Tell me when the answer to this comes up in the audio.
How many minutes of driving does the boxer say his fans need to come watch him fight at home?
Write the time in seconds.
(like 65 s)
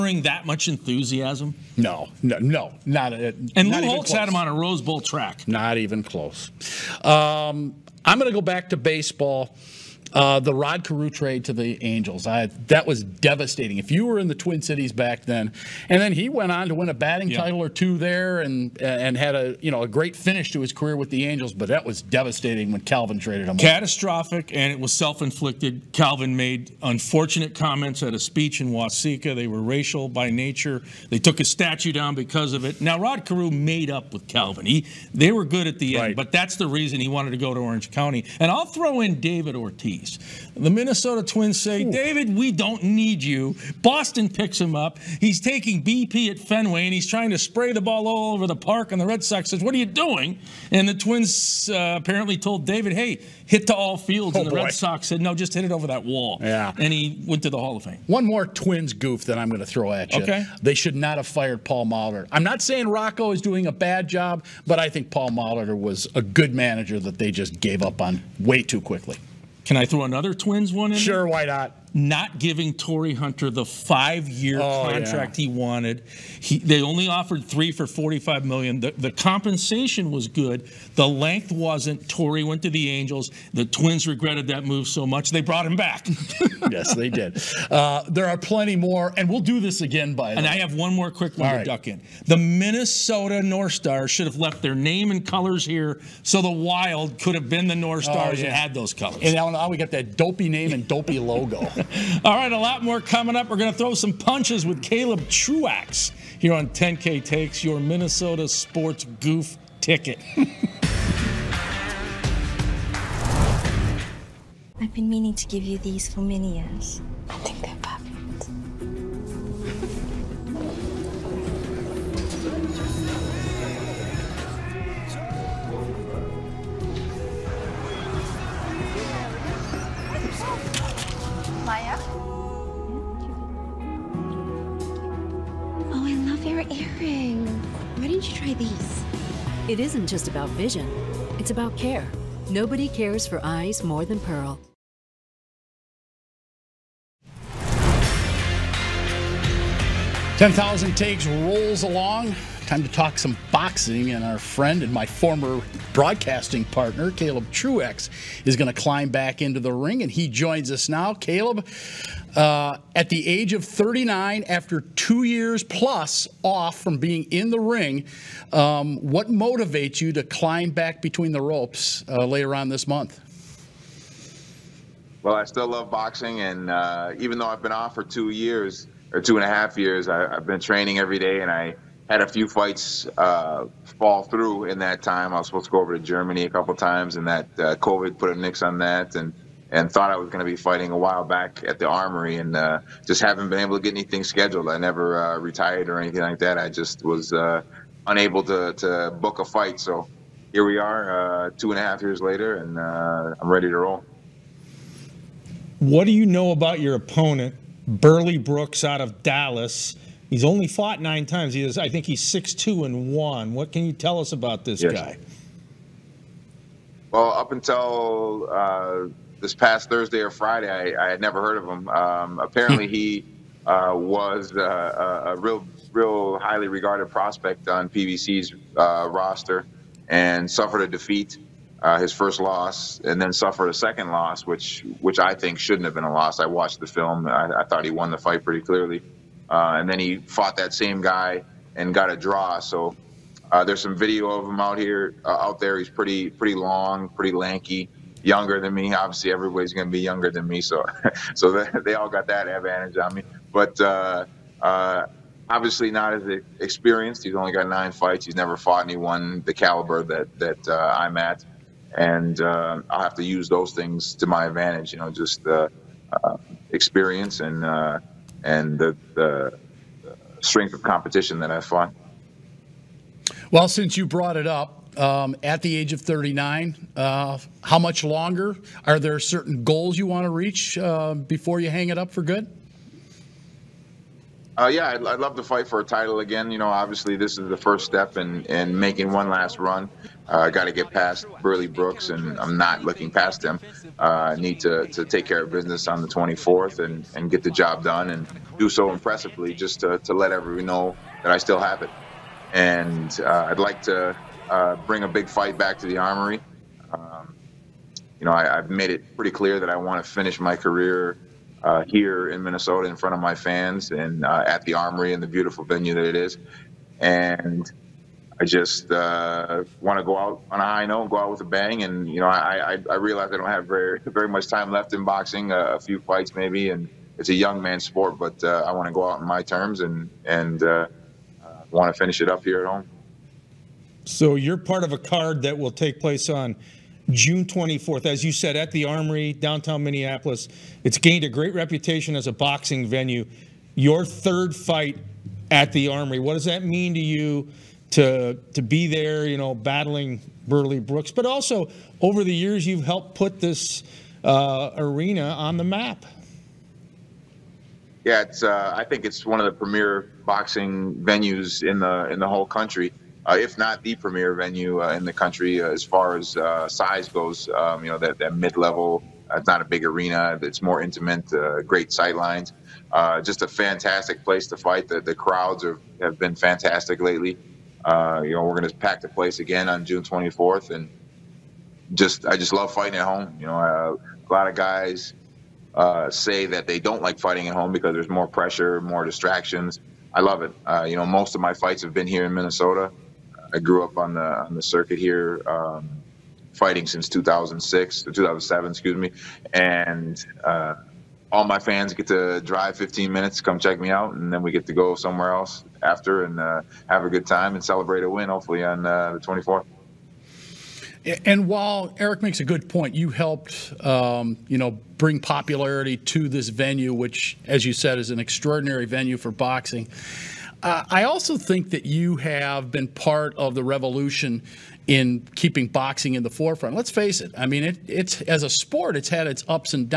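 402 s.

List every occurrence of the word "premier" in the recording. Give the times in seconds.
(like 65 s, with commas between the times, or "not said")
359 s, 363 s.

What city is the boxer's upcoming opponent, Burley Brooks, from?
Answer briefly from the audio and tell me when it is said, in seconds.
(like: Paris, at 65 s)
Dallas, at 209 s.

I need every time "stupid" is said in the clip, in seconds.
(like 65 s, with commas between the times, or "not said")
not said.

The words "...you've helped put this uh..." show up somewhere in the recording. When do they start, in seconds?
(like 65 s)
352 s.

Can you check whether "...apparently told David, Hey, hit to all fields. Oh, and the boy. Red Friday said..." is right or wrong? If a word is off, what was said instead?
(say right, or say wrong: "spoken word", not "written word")
wrong: "Sox", not "Friday".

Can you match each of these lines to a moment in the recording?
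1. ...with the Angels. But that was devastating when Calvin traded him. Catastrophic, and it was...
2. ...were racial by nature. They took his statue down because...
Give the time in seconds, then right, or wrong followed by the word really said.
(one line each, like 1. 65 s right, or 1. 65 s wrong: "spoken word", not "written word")
1. 20 s right
2. 29 s right.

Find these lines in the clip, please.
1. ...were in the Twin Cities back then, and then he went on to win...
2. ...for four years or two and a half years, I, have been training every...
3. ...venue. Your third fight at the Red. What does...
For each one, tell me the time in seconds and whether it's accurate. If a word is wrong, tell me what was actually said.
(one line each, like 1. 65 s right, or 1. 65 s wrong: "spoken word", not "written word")
1. 14 s right
2. 177 s wrong: "two", not "four"
3. 342 s wrong: "Armory", not "Red".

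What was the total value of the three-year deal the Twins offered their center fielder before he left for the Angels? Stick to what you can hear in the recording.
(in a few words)
45 million.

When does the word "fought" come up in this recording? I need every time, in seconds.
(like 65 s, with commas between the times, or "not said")
210 s, 240 s, 258 s, 271 s.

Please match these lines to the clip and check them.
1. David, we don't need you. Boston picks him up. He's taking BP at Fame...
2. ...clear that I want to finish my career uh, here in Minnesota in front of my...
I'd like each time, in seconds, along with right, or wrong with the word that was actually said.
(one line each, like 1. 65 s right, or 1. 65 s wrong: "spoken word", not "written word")
1. 41 s wrong: "Fenway", not "Fame"
2. 309 s right.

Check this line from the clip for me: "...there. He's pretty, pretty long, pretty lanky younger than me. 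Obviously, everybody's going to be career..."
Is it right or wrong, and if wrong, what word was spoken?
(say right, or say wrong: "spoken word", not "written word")
wrong: "younger", not "career".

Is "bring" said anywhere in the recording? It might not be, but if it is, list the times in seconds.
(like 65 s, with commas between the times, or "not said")
304 s, 414 s.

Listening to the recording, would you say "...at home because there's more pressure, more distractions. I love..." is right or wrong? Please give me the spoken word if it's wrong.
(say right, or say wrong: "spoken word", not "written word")
right.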